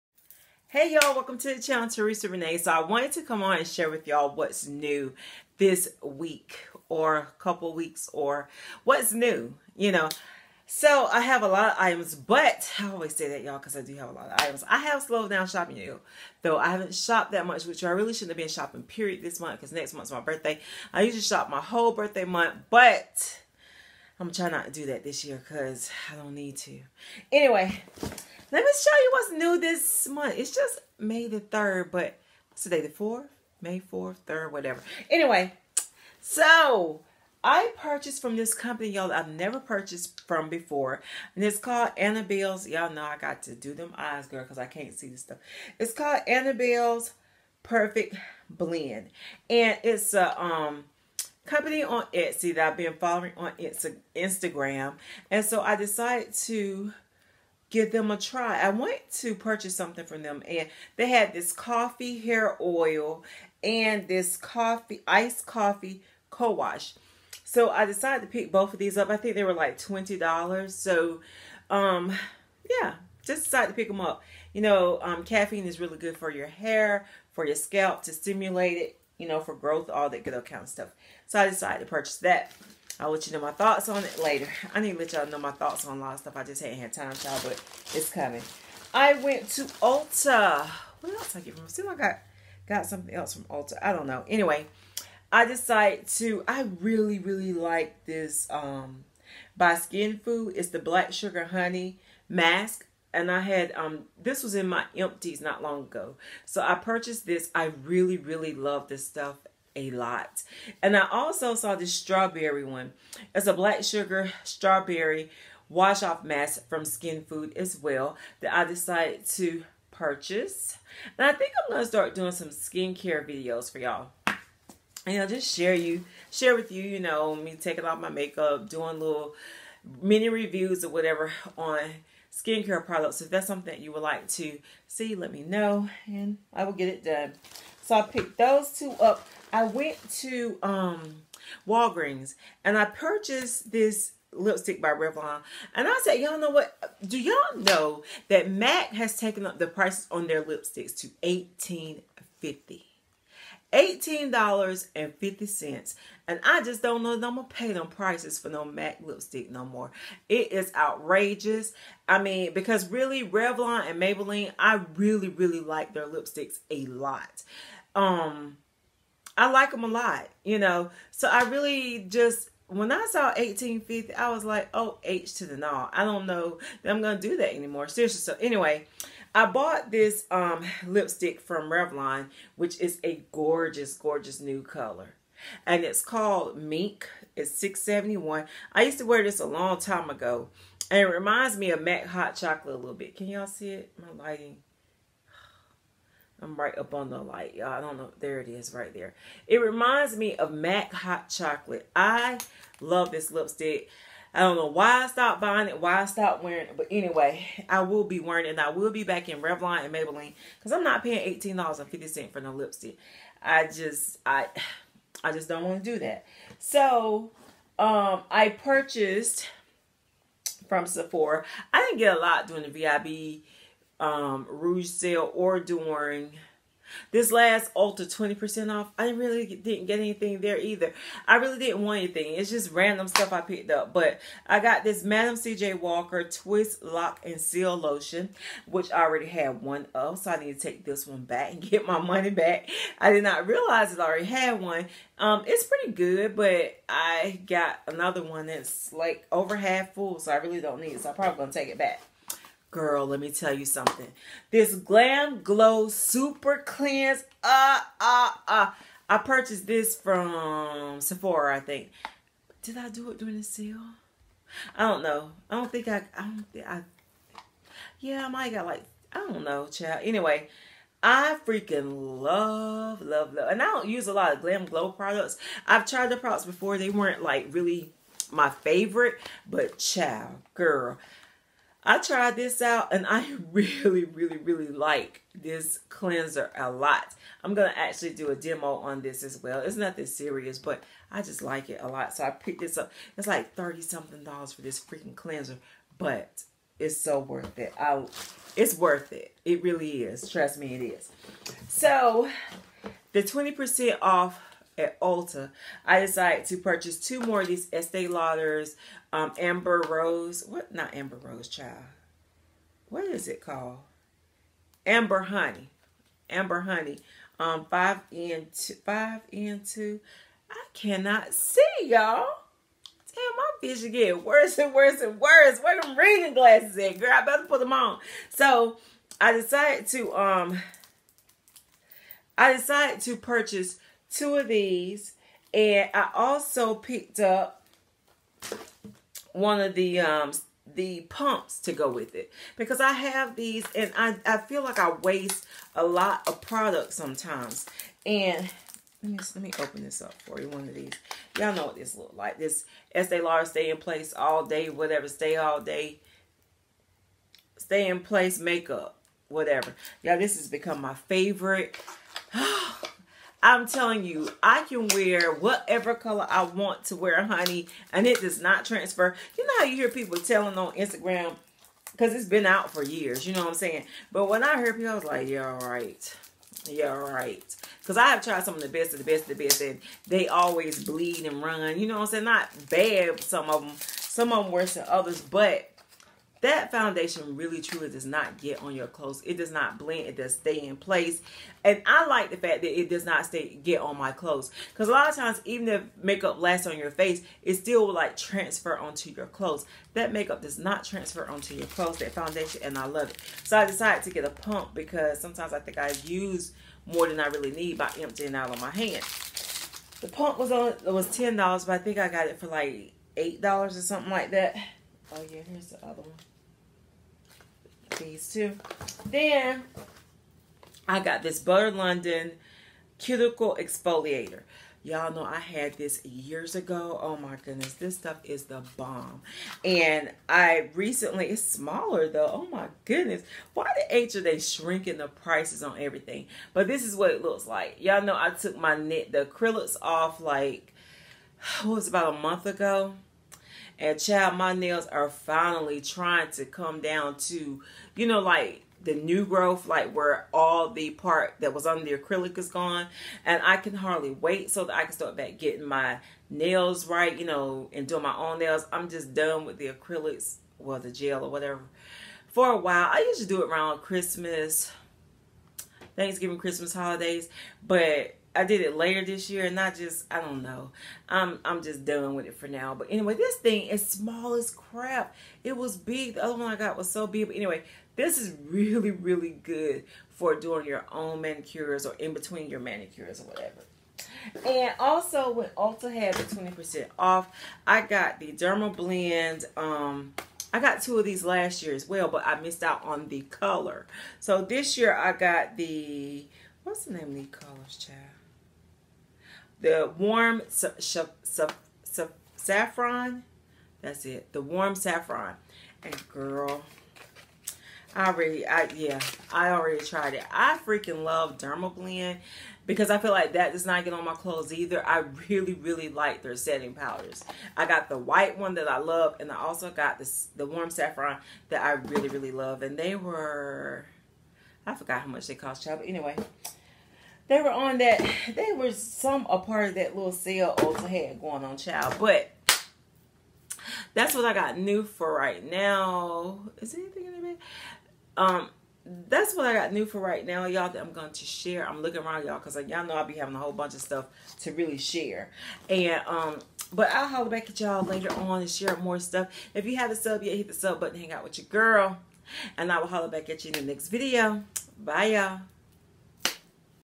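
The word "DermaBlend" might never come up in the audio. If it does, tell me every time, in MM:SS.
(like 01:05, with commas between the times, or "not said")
08:08, 08:31.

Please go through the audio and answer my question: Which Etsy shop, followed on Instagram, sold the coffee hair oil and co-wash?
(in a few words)
Annabelle's Perfect Blend.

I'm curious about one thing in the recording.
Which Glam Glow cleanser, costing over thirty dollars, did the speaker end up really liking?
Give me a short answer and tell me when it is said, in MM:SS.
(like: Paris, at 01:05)
Super Cleanse, at 04:15.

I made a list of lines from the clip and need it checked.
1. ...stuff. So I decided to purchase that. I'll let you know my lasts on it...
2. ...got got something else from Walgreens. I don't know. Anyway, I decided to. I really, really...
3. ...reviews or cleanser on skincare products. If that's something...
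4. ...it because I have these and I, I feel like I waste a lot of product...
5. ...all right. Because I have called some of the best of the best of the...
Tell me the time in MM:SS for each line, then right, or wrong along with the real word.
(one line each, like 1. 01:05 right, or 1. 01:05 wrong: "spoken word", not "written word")
1. 01:20 wrong: "thoughts", not "lasts"
2. 01:31 wrong: "Ulta", not "Walgreens"
3. 02:10 wrong: "whatever", not "cleanser"
4. 05:42 right
5. 06:16 wrong: "tried", not "called".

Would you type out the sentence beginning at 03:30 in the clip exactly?
Because I'm not paying $18.50 for no lipstick.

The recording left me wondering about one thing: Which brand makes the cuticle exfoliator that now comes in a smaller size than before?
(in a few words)
Butter London.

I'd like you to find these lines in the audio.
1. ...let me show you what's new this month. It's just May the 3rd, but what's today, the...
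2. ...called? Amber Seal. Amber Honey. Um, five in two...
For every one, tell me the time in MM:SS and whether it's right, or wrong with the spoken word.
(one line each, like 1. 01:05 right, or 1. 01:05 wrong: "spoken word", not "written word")
1. 00:28 right
2. 05:13 wrong: "Honey", not "Seal".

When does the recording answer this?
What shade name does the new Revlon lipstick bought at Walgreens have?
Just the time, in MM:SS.
03:06.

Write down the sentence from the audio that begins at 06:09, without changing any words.
You know how you hear people telling on Instagram, because it's been out for years, you know what I'm saying?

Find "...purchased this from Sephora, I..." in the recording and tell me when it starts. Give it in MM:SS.
04:19.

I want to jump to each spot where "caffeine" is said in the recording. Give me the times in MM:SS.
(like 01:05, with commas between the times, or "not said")
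01:15.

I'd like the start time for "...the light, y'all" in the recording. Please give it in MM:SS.
03:17.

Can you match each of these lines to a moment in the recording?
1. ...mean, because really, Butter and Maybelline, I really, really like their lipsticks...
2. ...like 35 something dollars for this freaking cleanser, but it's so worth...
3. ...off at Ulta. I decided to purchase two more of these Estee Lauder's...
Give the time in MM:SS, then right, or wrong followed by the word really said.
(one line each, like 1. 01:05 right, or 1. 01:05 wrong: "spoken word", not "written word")
1. 02:42 wrong: "Revlon", not "Butter"
2. 04:53 wrong: "30", not "35"
3. 05:04 right.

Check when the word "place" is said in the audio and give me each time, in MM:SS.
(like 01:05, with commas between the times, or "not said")
05:53, 05:57, 06:30.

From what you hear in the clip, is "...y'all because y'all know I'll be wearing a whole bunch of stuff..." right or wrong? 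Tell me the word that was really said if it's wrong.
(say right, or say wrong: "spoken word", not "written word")
wrong: "having", not "wearing".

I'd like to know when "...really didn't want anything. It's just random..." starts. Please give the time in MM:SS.
03:51.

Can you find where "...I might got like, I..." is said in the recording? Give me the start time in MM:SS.
04:28.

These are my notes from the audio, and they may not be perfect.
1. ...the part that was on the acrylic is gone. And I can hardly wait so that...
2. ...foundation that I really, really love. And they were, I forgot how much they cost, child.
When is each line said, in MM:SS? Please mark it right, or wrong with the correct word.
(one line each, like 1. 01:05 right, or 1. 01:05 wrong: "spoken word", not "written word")
1. 07:30 right
2. 08:40 wrong: "saffron", not "foundation".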